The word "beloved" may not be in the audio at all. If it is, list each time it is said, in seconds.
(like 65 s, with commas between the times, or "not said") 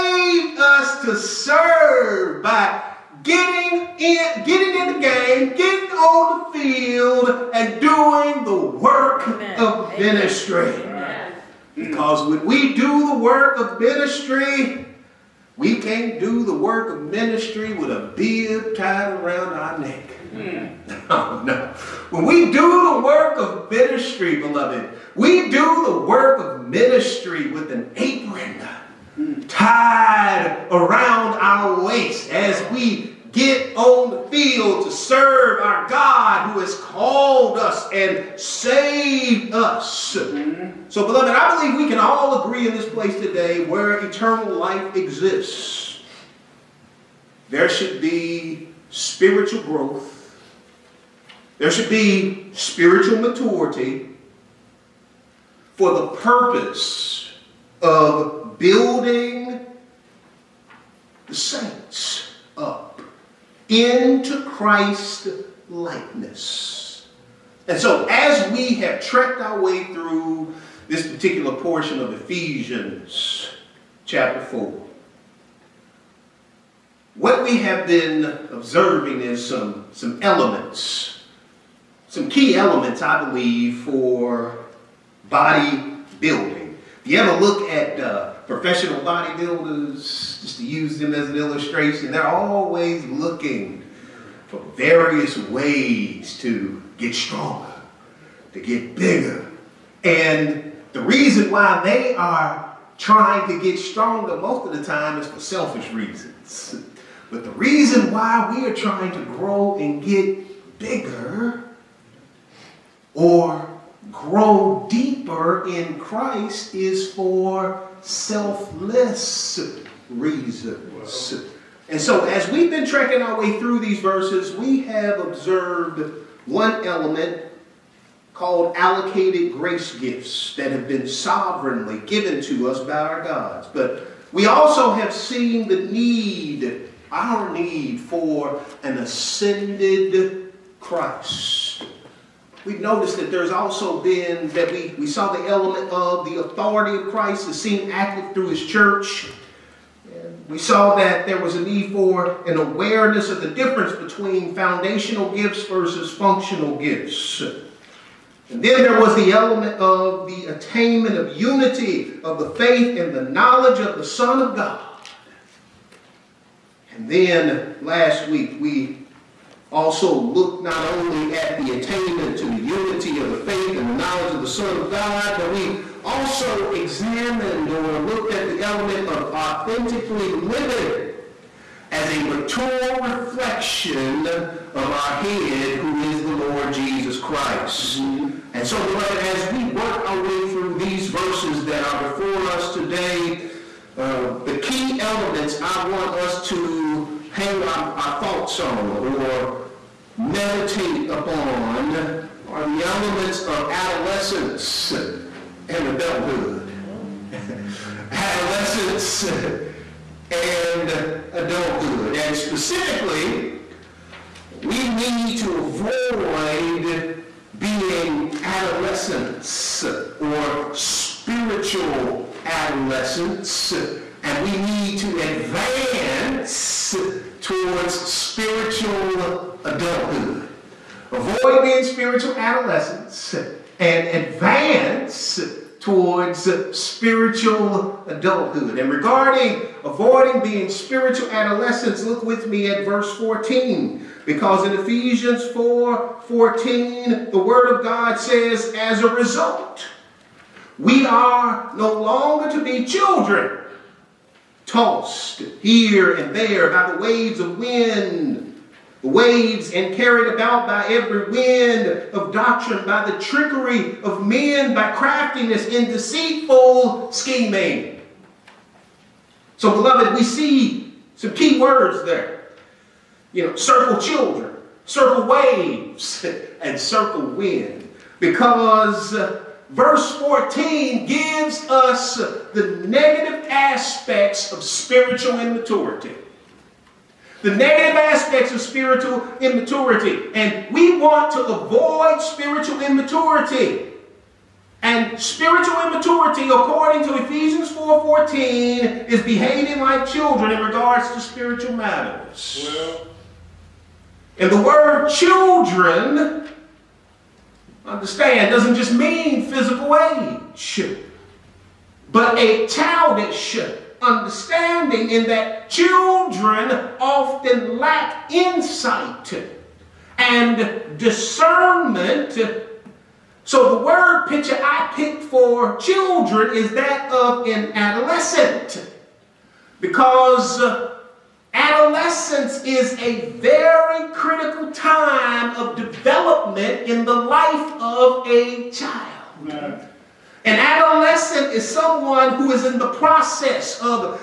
24 s, 41 s, 188 s, 269 s.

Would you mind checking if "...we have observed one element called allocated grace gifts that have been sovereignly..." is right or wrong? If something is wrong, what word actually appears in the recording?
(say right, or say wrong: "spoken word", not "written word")
right.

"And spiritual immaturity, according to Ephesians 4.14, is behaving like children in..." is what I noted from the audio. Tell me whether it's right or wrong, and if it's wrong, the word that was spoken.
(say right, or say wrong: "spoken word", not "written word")
right.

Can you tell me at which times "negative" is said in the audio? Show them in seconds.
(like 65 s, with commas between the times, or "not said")
282 s, 287 s.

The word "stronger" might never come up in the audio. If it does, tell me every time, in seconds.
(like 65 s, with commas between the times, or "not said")
97 s, 103 s.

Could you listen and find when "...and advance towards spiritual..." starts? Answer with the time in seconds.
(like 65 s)
233 s.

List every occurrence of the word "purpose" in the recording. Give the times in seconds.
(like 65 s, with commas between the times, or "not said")
56 s.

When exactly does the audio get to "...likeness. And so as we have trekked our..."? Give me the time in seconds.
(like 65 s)
65 s.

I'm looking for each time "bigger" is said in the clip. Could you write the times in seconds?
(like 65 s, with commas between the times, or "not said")
98 s, 110 s.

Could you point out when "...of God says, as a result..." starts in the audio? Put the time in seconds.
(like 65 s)
247 s.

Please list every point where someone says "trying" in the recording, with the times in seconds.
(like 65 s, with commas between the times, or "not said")
102 s, 108 s.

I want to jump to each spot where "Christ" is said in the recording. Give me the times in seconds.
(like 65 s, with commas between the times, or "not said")
64 s, 115 s, 140 s, 147 s, 187 s.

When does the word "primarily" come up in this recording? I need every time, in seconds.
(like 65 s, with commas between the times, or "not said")
not said.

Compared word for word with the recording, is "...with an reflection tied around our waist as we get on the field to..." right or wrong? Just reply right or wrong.
wrong.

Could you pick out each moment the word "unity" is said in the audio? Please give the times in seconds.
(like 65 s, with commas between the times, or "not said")
161 s, 172 s.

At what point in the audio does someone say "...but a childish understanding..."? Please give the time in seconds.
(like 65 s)
312 s.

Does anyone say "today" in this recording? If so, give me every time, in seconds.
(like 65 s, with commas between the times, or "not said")
43 s, 192 s.